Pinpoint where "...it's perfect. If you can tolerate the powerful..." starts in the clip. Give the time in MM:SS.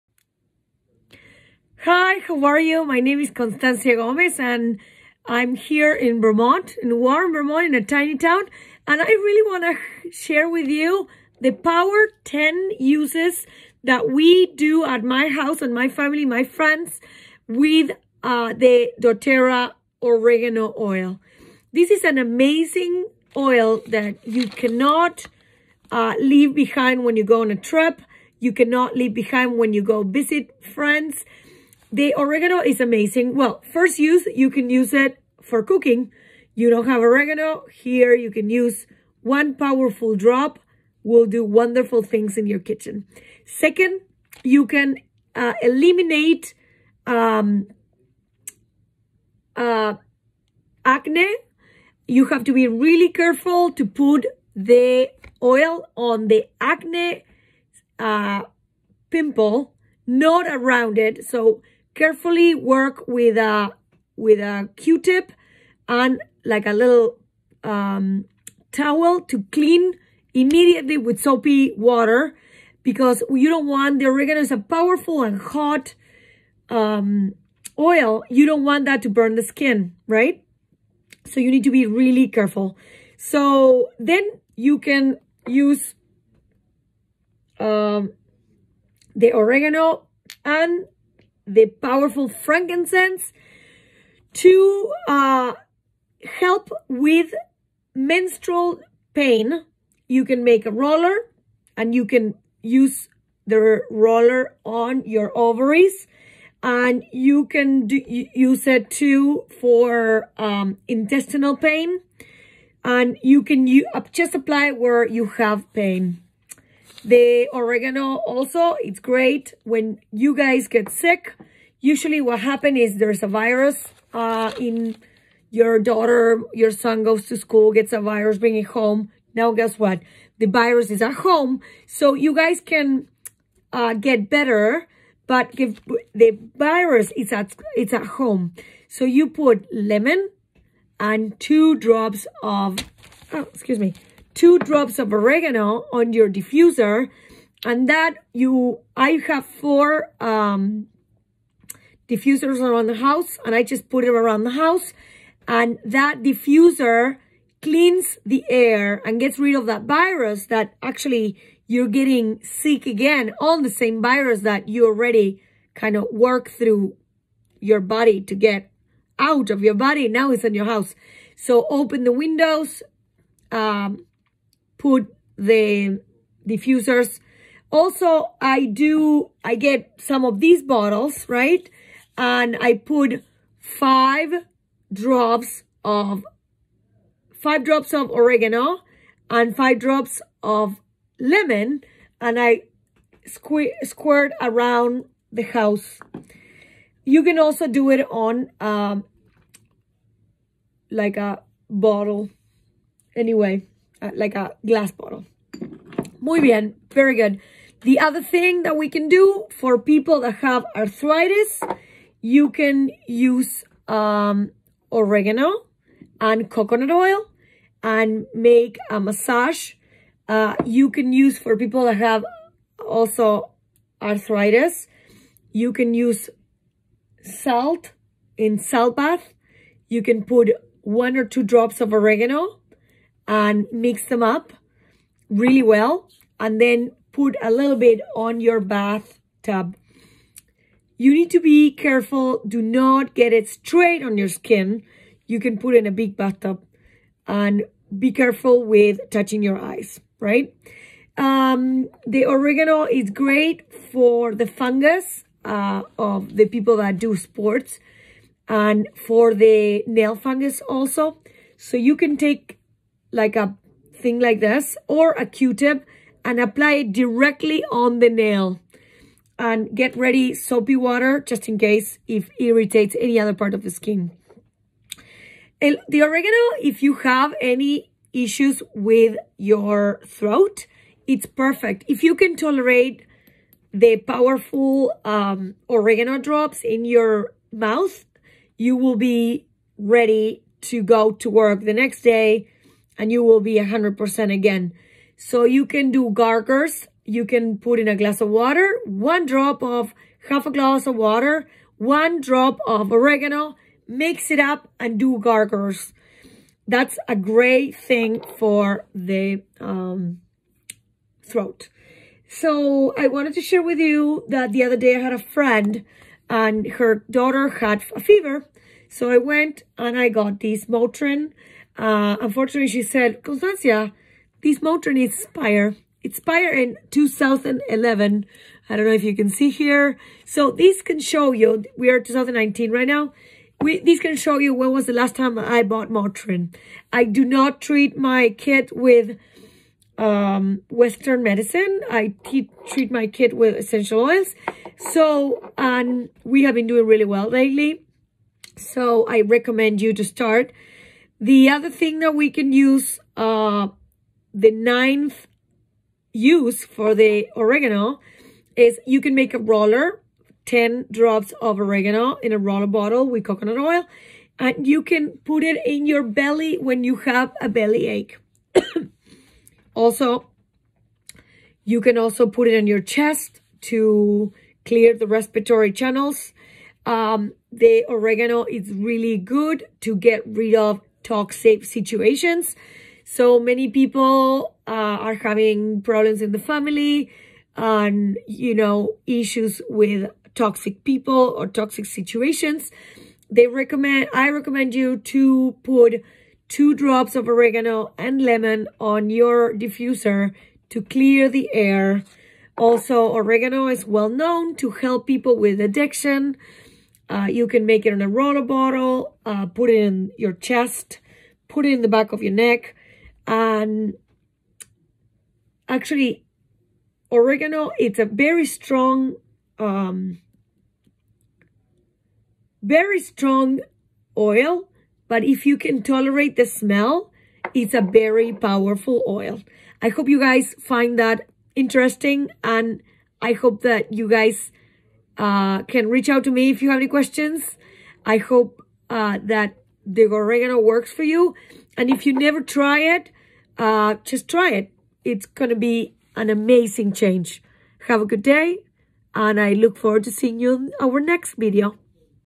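04:41.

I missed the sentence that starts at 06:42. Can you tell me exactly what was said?
Also, oregano is well known to help people with addiction.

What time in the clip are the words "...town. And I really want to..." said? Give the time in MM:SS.
00:08.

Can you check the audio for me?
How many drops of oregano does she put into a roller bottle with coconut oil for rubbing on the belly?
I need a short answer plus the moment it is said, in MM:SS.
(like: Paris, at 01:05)
10, at 06:00.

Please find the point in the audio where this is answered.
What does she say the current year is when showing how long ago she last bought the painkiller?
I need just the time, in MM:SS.
05:31.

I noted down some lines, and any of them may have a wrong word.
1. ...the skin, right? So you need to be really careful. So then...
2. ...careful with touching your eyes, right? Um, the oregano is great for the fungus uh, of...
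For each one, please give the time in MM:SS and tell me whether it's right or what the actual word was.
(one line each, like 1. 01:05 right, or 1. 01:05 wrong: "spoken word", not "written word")
1. 01:19 right
2. 04:08 right.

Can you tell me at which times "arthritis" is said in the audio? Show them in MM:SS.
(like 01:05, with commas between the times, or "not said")
03:30, 03:44.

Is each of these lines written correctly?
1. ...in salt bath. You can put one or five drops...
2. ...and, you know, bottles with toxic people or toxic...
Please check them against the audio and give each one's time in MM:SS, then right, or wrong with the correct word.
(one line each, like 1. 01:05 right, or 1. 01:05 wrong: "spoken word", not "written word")
1. 03:48 wrong: "two", not "five"
2. 06:27 wrong: "issues", not "bottles".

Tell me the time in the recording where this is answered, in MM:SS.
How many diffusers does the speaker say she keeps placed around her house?
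02:29.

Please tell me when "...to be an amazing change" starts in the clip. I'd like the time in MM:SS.
07:25.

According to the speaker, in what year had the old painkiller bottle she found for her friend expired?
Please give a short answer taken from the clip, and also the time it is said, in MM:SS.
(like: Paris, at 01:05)
2011, at 05:26.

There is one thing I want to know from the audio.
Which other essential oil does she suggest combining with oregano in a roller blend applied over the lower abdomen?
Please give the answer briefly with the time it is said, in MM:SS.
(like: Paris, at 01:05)
frankincense, at 01:32.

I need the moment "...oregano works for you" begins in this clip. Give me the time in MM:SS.
07:20.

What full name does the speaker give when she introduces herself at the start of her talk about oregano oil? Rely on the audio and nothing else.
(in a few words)
Constancia Gomez.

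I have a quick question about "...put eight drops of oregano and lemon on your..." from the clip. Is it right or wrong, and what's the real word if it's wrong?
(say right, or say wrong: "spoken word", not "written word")
wrong: "two", not "eight".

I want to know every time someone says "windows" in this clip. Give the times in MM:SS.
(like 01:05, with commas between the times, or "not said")
02:52.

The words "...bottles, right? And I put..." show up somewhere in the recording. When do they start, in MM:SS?
03:00.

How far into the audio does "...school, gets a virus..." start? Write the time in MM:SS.
02:07.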